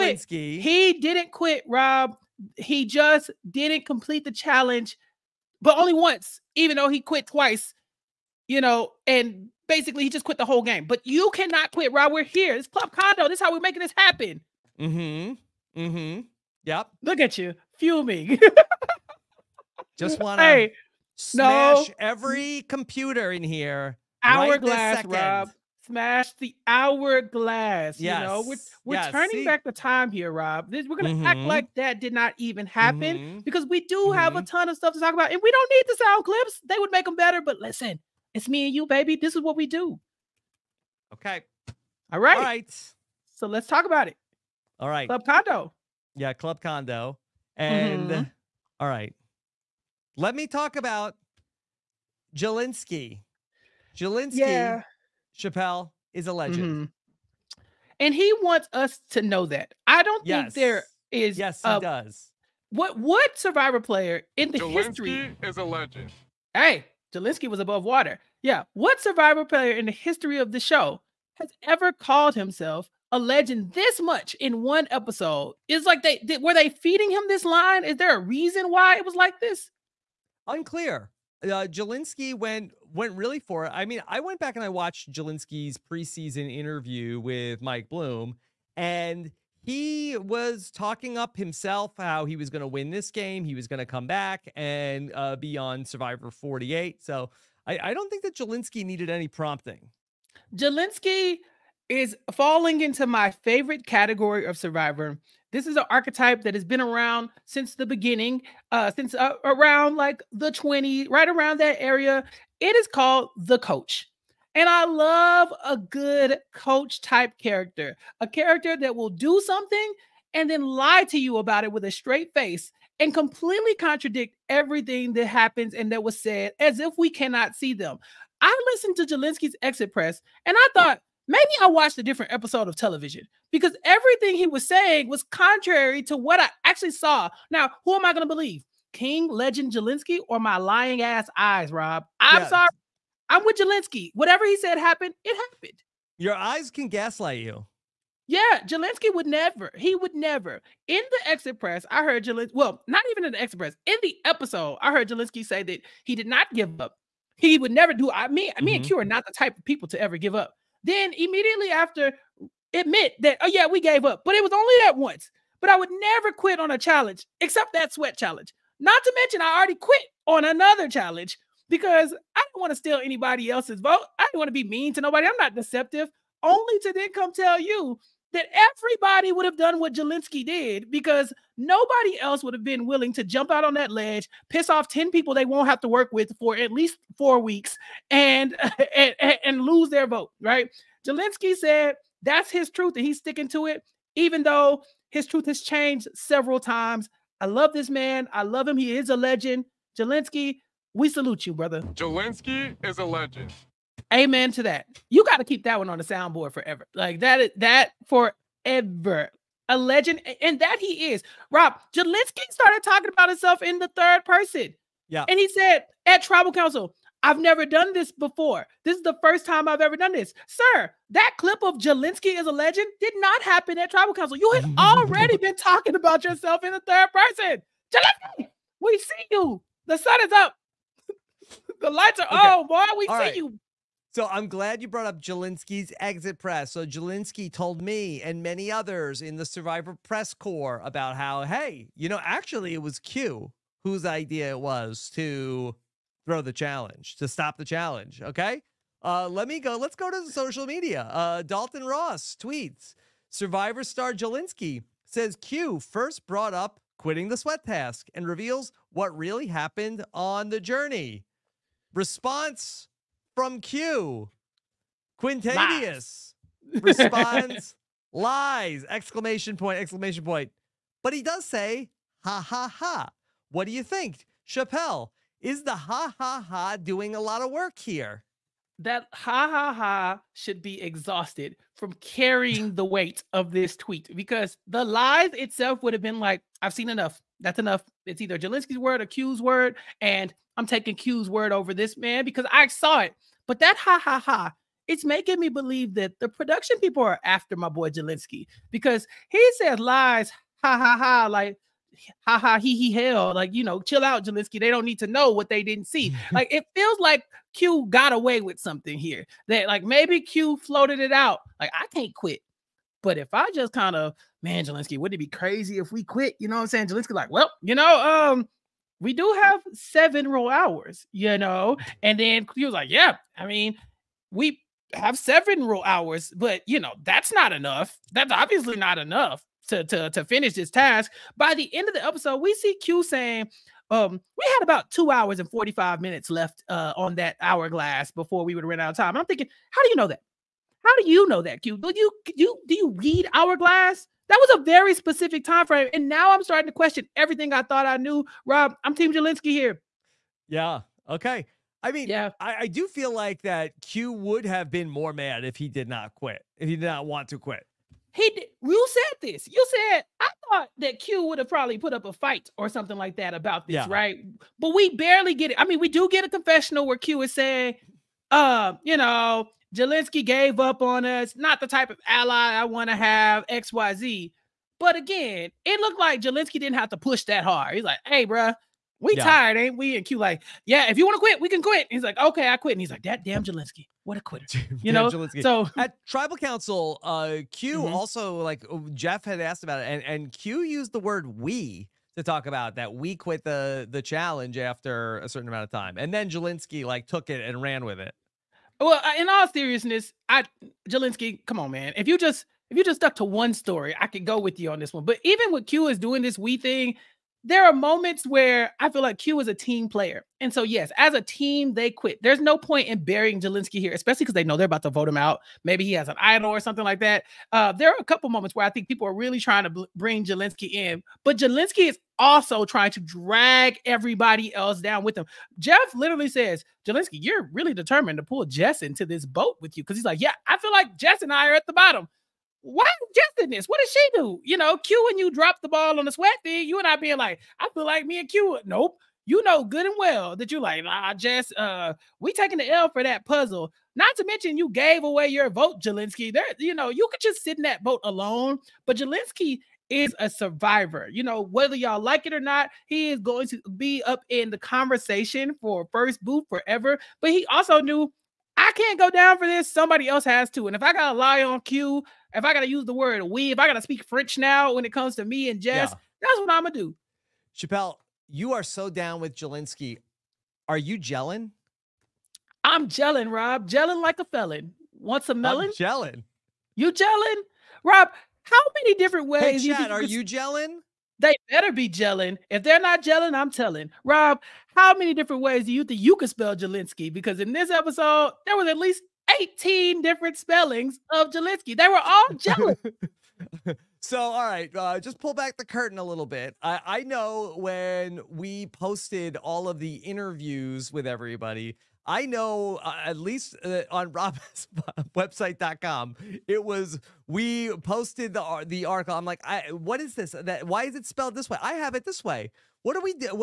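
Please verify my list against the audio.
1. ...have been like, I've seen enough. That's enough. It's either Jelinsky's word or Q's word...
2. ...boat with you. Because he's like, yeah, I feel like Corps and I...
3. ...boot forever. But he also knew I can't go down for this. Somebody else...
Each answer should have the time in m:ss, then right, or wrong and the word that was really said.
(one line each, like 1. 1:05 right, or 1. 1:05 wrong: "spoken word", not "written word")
1. 4:45 right
2. 7:09 wrong: "Jess", not "Corps"
3. 7:36 right.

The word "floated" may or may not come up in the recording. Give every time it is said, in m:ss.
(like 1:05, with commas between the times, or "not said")
5:10.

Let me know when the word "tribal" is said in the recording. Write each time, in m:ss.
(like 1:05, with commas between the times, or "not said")
3:36, 3:43, 6:26.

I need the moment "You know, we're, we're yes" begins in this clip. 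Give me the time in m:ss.
0:28.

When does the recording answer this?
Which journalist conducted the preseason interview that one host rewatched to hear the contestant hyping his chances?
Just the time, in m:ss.
1:27.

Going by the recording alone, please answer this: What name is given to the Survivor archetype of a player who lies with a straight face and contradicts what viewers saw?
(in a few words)
The coach.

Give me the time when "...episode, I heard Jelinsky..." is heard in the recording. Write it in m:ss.
2:34.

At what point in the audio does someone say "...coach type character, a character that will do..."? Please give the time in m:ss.
1:56.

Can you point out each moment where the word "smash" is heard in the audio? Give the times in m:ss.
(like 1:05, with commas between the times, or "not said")
0:21, 0:25.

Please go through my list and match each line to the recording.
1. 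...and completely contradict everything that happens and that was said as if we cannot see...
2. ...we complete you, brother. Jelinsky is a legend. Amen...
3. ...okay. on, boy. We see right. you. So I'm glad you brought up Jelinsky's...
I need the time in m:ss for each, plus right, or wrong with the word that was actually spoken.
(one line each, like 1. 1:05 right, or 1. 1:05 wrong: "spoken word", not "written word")
1. 2:02 right
2. 3:20 wrong: "salute", not "complete"
3. 3:52 right.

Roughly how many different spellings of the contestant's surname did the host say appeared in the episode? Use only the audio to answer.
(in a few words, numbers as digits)
18.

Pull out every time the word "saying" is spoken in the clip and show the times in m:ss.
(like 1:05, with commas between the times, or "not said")
2:14, 5:16, 5:33, 6:07.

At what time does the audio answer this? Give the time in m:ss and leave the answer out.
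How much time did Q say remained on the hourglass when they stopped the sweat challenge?
5:34.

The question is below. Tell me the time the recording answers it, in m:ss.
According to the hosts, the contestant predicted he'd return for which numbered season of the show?
1:35.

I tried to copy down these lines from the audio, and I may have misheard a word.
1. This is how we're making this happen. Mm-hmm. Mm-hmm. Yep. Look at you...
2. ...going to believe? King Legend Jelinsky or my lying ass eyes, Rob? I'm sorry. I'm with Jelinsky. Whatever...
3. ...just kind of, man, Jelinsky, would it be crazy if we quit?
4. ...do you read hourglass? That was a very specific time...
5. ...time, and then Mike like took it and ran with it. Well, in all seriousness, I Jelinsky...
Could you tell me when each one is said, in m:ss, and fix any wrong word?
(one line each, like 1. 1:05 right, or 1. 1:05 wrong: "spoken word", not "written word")
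1. 0:13 right
2. 2:18 right
3. 5:13 right
4. 5:42 right
5. 6:35 wrong: "Jelinsky", not "Mike".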